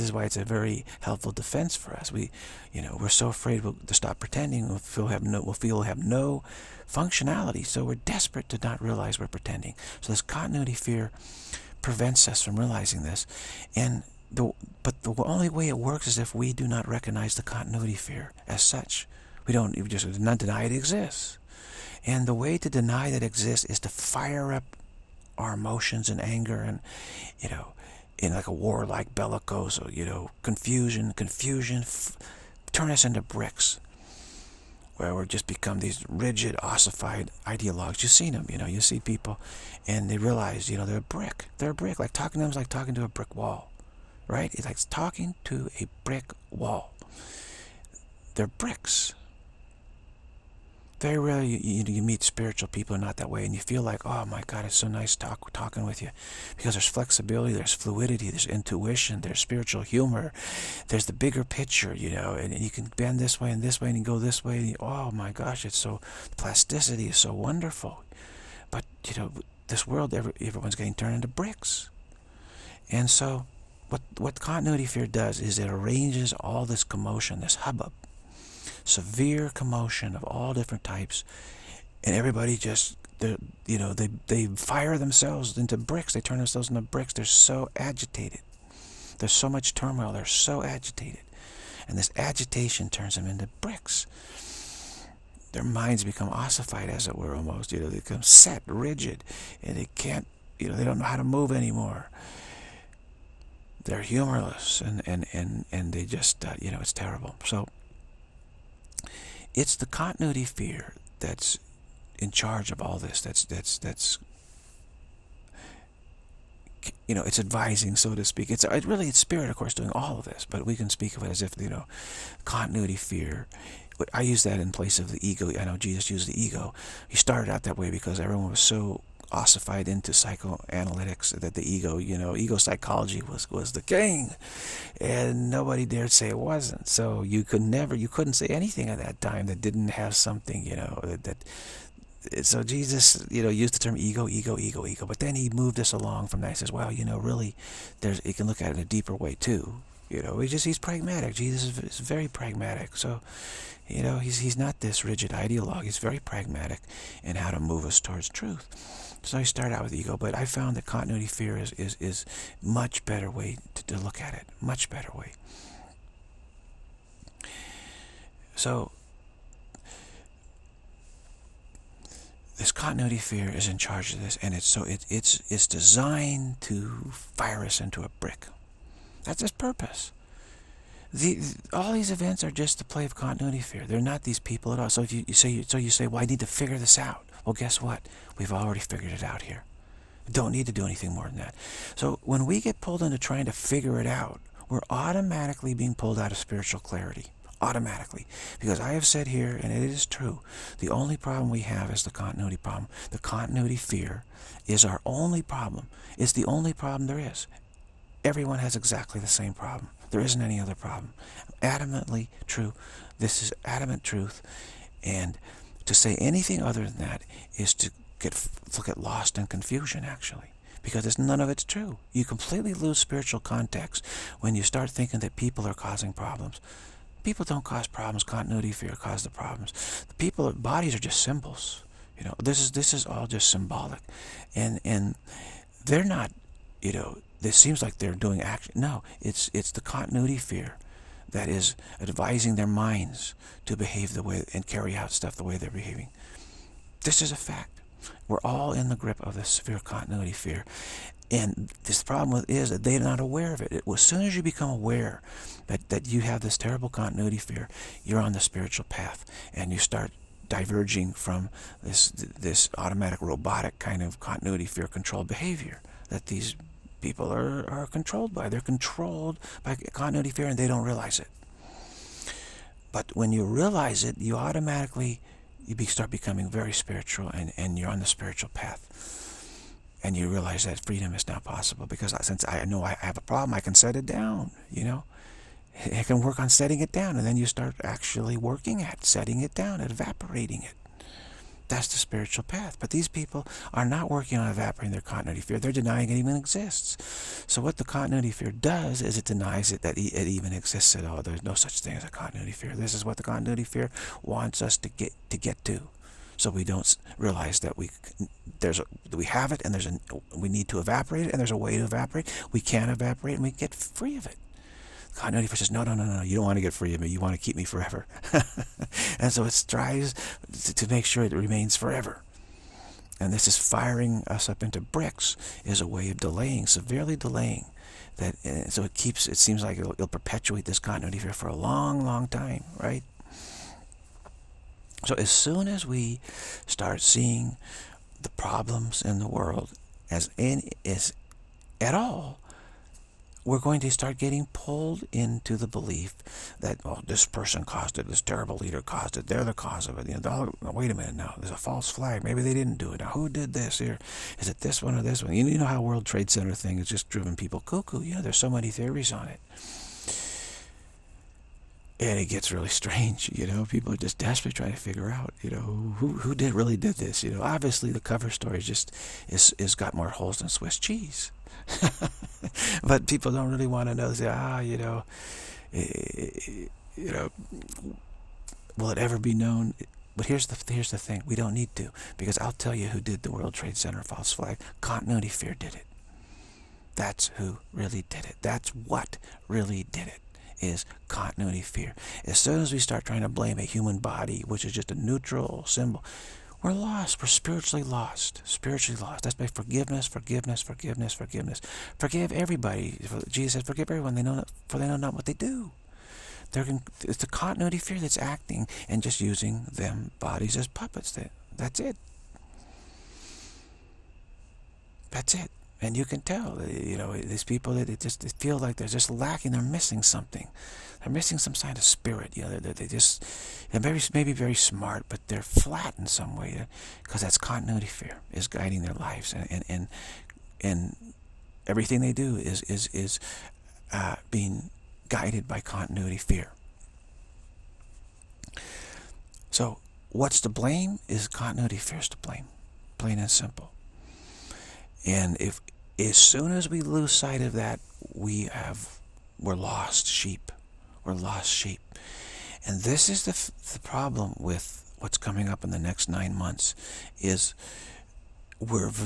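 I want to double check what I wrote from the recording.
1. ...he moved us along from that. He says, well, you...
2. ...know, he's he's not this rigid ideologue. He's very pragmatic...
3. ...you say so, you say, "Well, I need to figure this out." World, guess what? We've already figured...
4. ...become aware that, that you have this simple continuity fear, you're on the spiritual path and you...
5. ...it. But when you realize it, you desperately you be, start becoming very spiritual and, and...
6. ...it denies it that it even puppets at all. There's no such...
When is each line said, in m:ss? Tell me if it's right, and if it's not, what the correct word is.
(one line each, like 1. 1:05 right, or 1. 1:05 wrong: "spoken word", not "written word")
1. 2:25 right
2. 2:34 right
3. 3:05 wrong: "Well", not "World"
4. 4:14 wrong: "terrible", not "simple"
5. 4:31 wrong: "automatically", not "desperately"
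6. 4:59 wrong: "exists", not "puppets".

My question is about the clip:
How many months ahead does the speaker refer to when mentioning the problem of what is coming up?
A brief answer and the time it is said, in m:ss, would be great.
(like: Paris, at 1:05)
9, at 7:36.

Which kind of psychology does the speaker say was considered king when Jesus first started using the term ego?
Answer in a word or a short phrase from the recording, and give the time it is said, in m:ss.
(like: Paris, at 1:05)
ego psychology, at 2:12.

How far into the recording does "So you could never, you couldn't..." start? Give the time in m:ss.
2:16.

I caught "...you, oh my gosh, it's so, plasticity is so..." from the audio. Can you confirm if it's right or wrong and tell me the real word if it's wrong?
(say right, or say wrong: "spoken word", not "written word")
right.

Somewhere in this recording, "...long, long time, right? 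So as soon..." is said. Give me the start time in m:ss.
5:31.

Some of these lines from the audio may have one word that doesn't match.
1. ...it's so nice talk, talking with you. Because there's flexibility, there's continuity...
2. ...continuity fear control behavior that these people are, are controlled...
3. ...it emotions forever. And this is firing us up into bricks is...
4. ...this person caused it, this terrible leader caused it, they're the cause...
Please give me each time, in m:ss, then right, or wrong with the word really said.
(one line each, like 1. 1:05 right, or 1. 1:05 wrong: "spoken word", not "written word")
1. 0:54 wrong: "fluidity", not "continuity"
2. 4:24 right
3. 5:21 wrong: "remains", not "emotions"
4. 5:47 right.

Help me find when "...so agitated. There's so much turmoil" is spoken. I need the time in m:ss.
1:27.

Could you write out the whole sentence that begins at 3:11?
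So when we get pulled into trying to figure it out, we're automatically being pulled out of spiritual clarity.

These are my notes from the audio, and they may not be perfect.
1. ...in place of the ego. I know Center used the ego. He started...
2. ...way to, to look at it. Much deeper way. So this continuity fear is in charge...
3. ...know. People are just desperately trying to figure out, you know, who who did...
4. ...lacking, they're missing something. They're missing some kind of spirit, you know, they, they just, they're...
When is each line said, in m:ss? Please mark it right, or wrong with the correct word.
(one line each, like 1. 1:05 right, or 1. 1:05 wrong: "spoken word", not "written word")
1. 2:04 wrong: "Jesus", not "Center"
2. 2:43 wrong: "better", not "deeper"
3. 6:03 right
4. 6:59 right.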